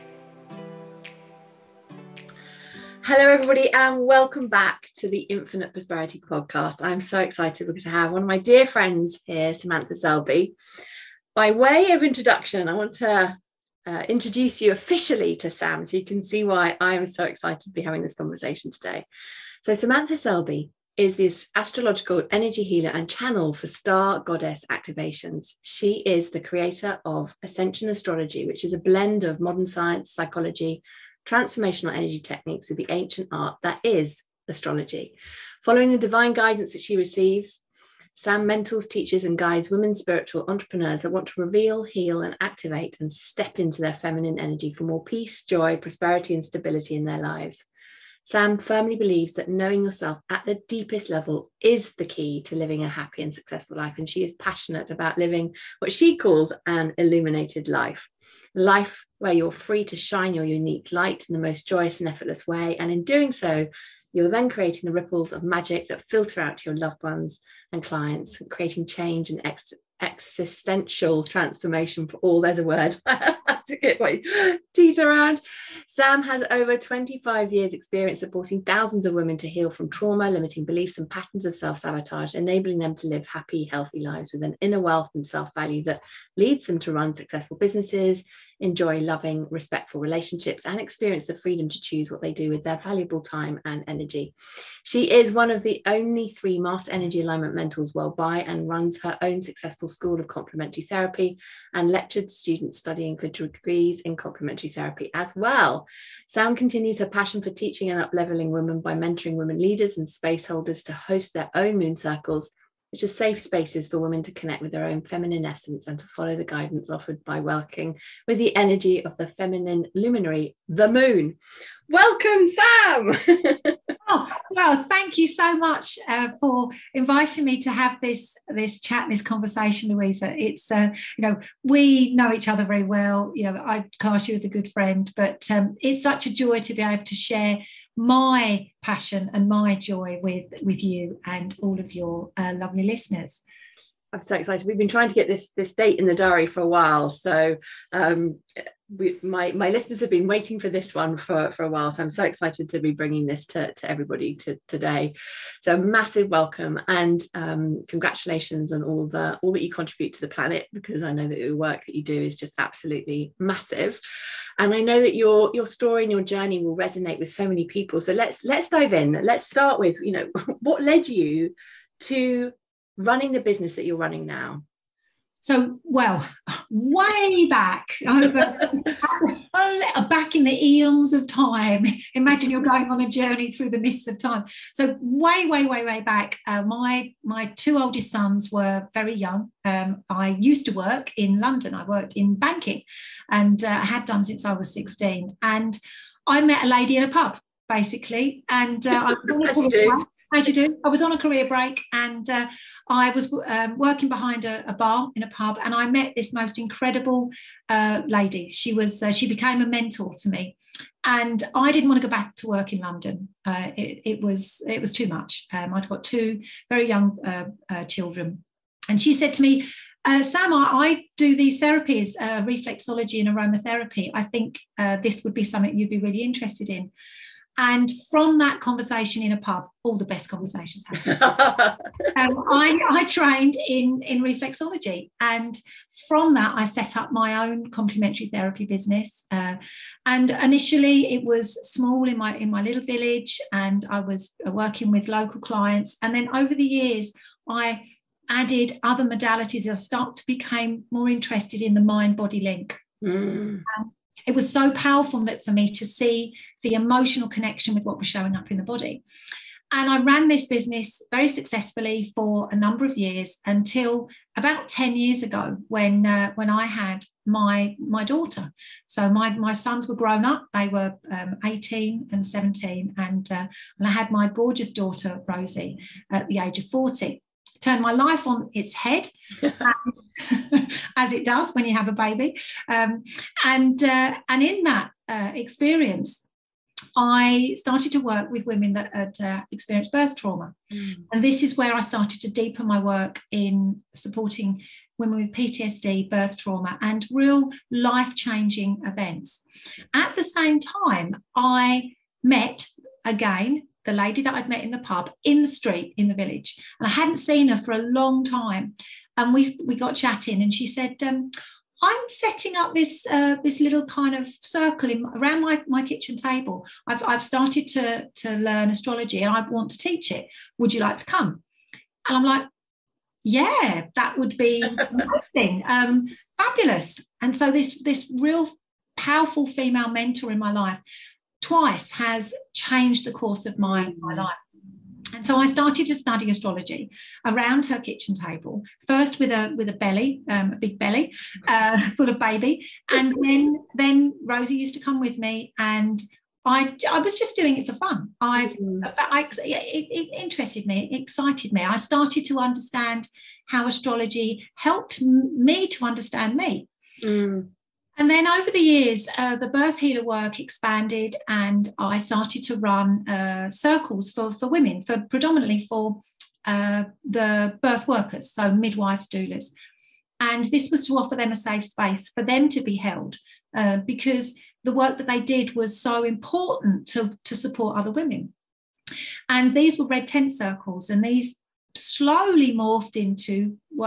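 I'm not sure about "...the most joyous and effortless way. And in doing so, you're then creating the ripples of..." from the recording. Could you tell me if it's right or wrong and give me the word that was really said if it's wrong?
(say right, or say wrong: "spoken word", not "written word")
right.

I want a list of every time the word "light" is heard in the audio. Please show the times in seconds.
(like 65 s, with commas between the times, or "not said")
60 s.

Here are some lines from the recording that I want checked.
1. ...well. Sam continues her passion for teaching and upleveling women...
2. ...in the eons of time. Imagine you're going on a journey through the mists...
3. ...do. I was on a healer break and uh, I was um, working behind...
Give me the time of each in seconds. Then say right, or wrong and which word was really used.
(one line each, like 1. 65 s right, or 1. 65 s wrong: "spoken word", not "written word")
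1. 105 s right
2. 180 s right
3. 200 s wrong: "career", not "healer".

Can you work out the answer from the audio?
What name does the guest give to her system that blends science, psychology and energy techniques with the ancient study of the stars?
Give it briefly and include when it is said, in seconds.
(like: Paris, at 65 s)
Ascension Astrology, at 27 s.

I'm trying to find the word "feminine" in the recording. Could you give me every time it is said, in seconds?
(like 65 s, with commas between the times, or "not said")
43 s, 115 s, 119 s.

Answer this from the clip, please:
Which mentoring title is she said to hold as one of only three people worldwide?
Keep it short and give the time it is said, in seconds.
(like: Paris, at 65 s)
Master Energy Alignment mentors, at 96 s.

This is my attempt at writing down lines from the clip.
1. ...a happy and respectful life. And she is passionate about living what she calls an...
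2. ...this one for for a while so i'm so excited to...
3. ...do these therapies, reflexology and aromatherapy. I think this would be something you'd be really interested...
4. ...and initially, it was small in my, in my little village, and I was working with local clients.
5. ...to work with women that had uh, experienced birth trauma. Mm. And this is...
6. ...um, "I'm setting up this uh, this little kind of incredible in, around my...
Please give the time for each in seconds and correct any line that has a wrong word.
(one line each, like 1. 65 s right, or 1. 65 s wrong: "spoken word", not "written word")
1. 52 s wrong: "successful", not "respectful"
2. 150 s right
3. 221 s right
4. 240 s right
5. 287 s right
6. 311 s wrong: "circle", not "incredible".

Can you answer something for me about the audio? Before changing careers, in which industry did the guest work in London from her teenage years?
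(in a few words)
Banking.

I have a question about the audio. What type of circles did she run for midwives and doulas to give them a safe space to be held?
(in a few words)
Red tent circles.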